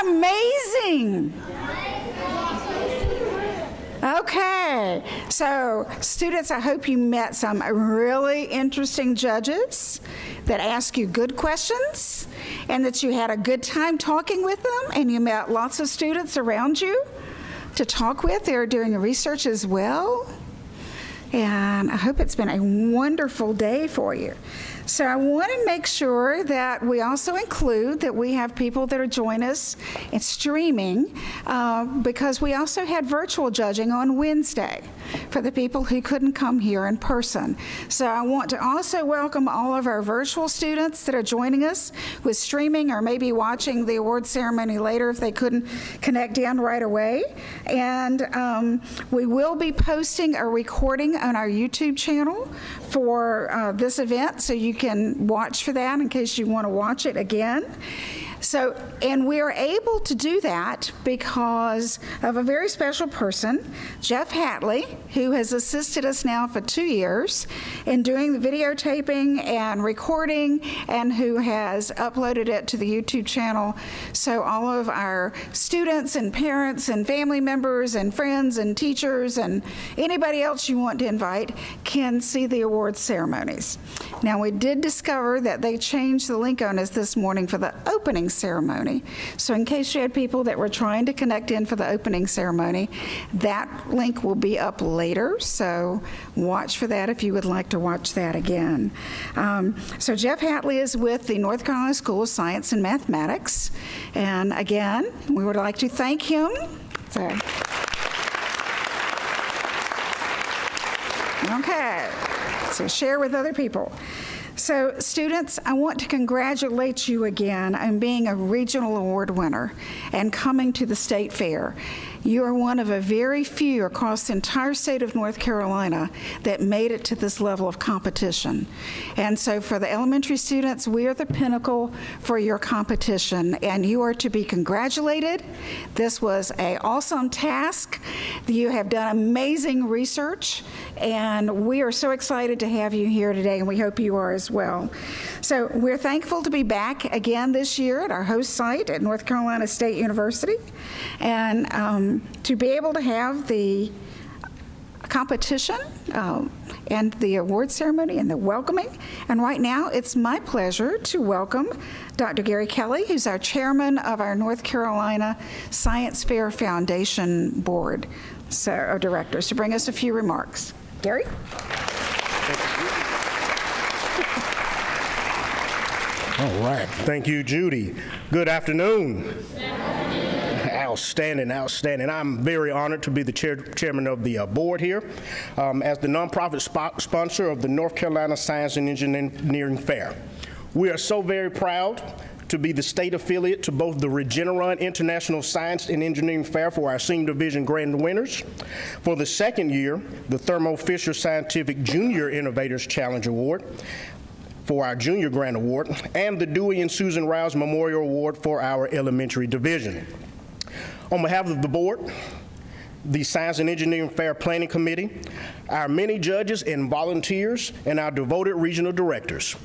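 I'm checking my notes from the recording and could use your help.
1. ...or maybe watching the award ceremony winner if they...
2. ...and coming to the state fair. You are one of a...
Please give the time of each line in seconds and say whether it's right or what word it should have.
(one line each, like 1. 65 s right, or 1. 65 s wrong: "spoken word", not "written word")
1. 42 s wrong: "later", not "winner"
2. 120 s right.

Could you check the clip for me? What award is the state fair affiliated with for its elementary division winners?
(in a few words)
Dewey and Susan Rouse Memorial Award.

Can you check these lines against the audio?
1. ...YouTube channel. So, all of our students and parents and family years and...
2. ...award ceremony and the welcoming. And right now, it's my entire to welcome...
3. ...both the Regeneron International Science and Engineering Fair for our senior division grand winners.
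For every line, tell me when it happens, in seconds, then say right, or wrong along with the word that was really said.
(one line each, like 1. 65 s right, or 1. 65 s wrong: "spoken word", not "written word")
1. 72 s wrong: "members", not "years"
2. 157 s wrong: "pleasure", not "entire"
3. 193 s right.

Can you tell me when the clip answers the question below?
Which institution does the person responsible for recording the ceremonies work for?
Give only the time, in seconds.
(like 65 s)
101 s.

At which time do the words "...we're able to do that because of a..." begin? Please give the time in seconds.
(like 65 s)
59 s.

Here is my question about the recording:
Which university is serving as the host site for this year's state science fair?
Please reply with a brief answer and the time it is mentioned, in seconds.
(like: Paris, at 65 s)
North Carolina State University, at 149 s.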